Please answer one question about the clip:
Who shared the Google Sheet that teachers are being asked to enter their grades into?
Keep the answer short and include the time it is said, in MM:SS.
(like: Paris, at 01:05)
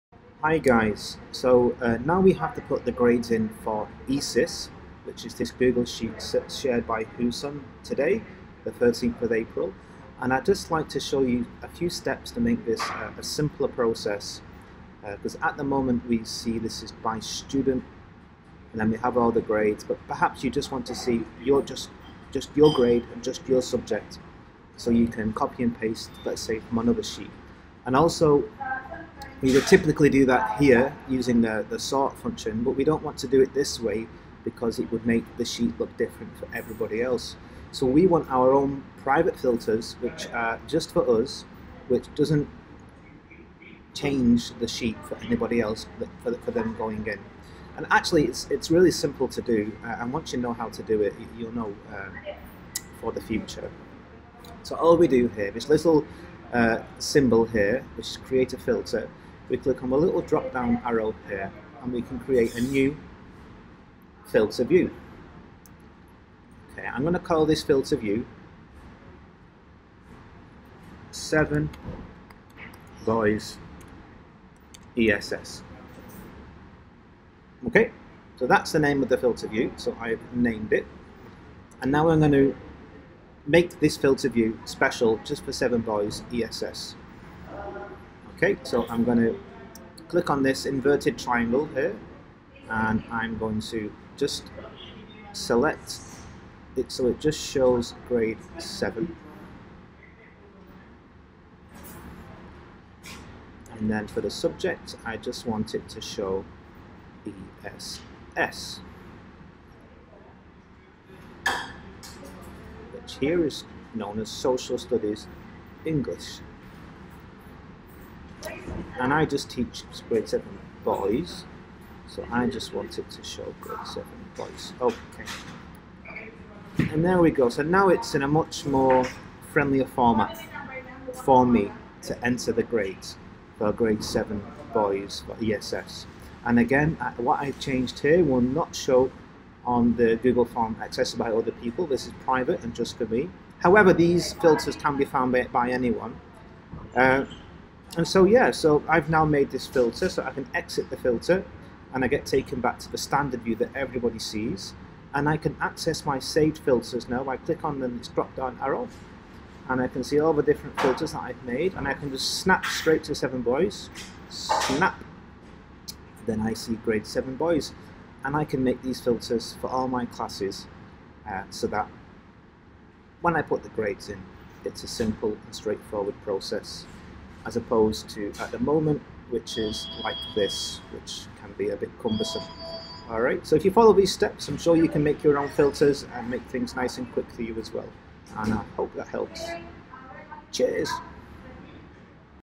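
Husun, at 00:07.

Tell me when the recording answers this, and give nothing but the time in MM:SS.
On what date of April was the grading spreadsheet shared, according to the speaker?
00:08.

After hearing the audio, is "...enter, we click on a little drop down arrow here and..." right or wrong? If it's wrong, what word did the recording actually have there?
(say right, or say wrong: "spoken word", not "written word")
wrong: "filter", not "enter".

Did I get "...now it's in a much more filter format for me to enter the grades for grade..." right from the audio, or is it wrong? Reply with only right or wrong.
wrong.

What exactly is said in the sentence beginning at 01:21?
And now I'm going to make this filter view special just for 7 Boys ESS.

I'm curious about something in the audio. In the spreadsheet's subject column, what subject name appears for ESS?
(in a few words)
Social Studies English.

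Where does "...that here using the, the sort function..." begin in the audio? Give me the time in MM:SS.
00:30.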